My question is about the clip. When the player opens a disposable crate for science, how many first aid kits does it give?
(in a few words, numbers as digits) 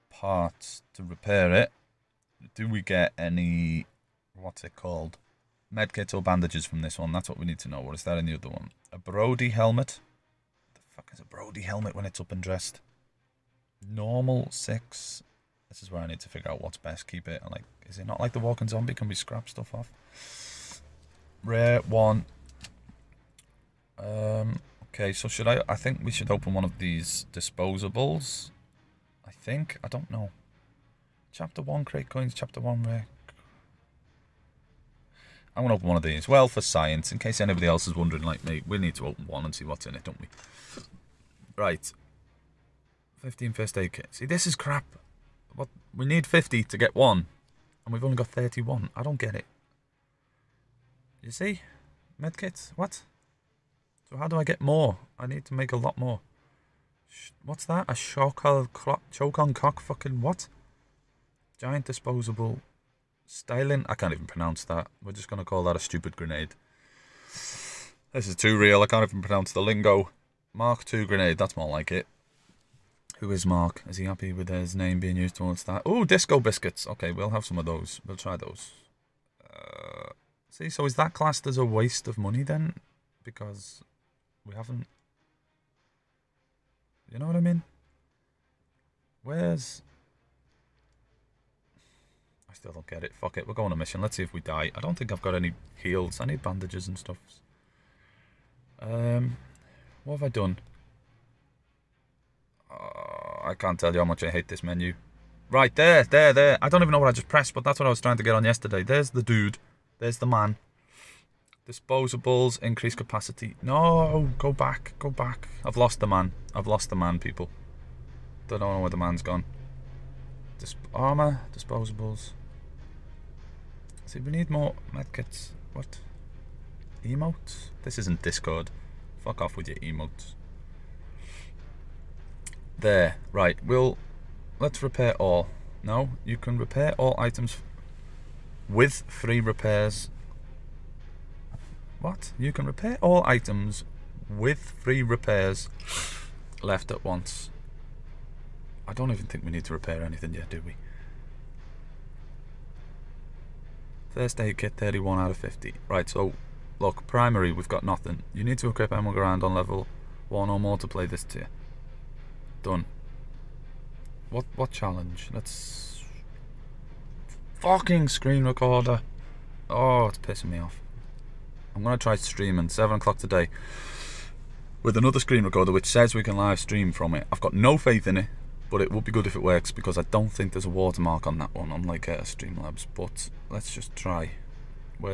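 15.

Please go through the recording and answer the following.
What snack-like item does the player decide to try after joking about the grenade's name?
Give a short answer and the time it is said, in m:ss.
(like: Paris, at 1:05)
Disco biscuits, at 1:16.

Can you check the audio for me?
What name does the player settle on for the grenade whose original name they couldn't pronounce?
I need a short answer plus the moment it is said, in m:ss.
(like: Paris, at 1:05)
Mark II grenade, at 1:10.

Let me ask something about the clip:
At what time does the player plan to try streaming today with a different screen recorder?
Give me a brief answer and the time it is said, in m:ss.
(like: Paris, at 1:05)
7 o'clock, at 2:52.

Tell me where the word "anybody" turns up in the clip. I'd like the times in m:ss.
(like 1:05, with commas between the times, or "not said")
0:37.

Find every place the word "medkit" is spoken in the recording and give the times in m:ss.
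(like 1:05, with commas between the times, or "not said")
0:05, 0:52, 2:04.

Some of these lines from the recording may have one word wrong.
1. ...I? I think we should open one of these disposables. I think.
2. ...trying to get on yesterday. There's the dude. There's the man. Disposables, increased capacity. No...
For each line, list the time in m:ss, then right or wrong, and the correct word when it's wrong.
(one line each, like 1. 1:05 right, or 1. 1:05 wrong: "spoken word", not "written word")
1. 0:25 right
2. 1:47 right.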